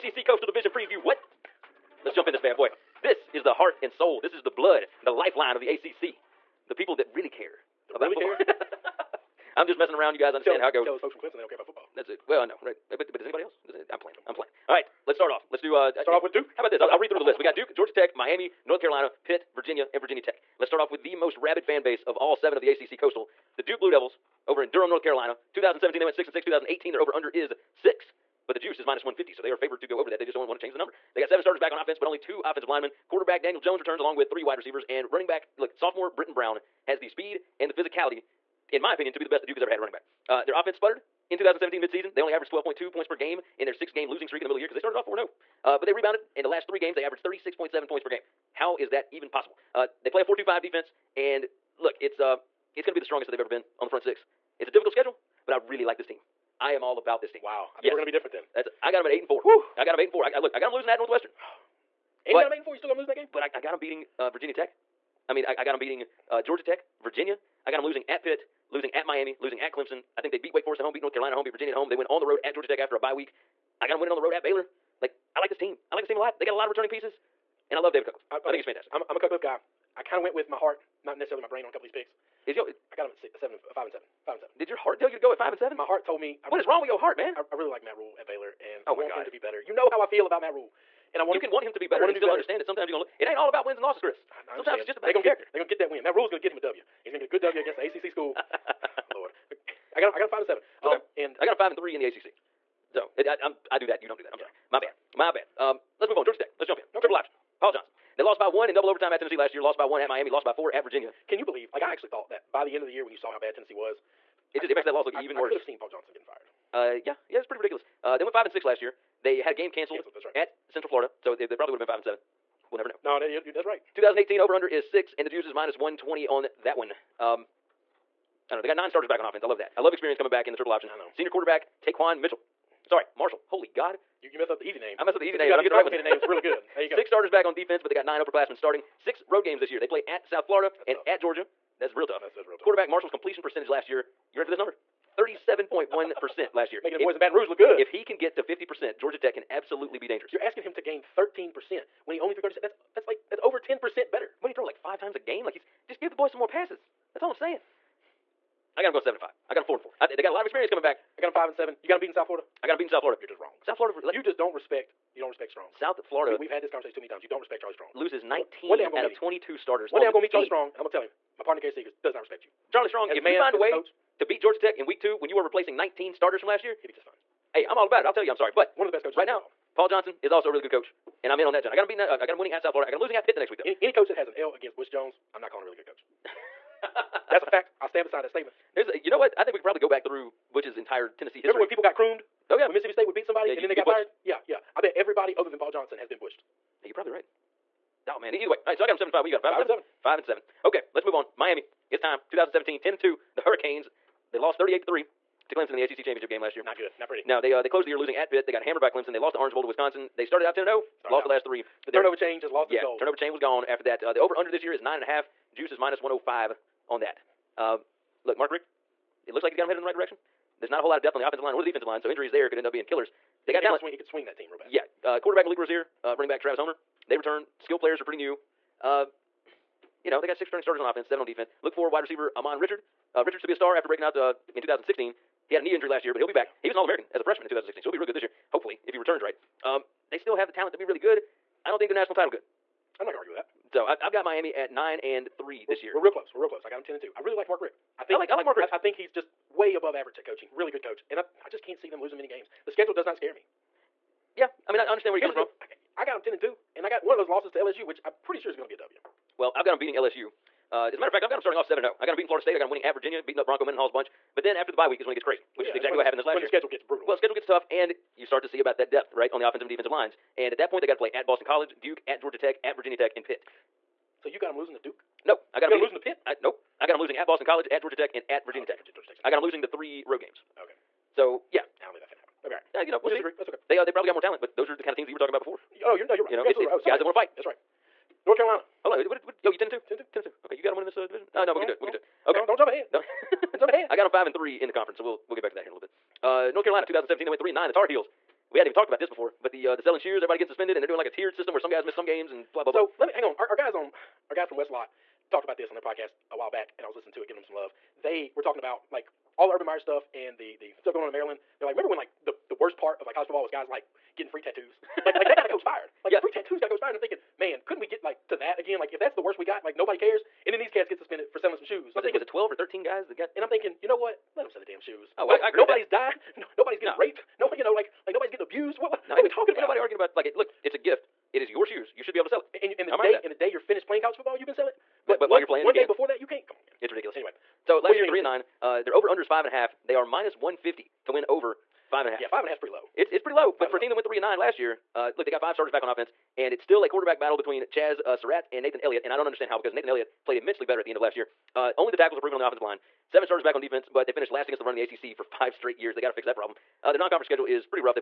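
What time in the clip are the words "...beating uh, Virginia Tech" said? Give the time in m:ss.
1:03.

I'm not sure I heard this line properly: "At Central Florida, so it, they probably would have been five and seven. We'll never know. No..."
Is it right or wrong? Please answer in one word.
right.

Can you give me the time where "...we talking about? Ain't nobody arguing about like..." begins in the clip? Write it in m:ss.
5:29.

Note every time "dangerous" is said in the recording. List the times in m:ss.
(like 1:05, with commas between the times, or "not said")
2:30.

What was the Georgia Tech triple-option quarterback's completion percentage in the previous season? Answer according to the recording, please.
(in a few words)
37.1%.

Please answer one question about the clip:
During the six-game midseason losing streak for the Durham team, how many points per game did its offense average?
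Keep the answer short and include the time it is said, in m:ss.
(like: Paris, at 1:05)
12.2, at 0:42.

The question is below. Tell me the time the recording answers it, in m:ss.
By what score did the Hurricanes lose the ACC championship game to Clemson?
3:24.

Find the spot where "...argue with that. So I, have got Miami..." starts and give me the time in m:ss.
4:03.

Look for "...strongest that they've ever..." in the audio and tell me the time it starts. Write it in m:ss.
0:53.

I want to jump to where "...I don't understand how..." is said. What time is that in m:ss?
5:49.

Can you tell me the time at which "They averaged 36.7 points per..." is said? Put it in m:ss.
0:46.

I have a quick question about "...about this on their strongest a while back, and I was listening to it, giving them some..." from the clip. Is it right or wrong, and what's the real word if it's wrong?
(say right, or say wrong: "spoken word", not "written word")
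wrong: "podcast", not "strongest".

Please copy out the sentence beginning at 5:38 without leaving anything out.
Uh, their over under is five and a half.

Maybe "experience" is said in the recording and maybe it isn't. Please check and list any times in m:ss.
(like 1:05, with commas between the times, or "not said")
2:09, 2:40.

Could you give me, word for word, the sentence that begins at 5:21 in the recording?
Was, it, thinking, was it twelve or thirteen guys that got?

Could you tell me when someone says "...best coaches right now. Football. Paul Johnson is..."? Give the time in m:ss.
2:58.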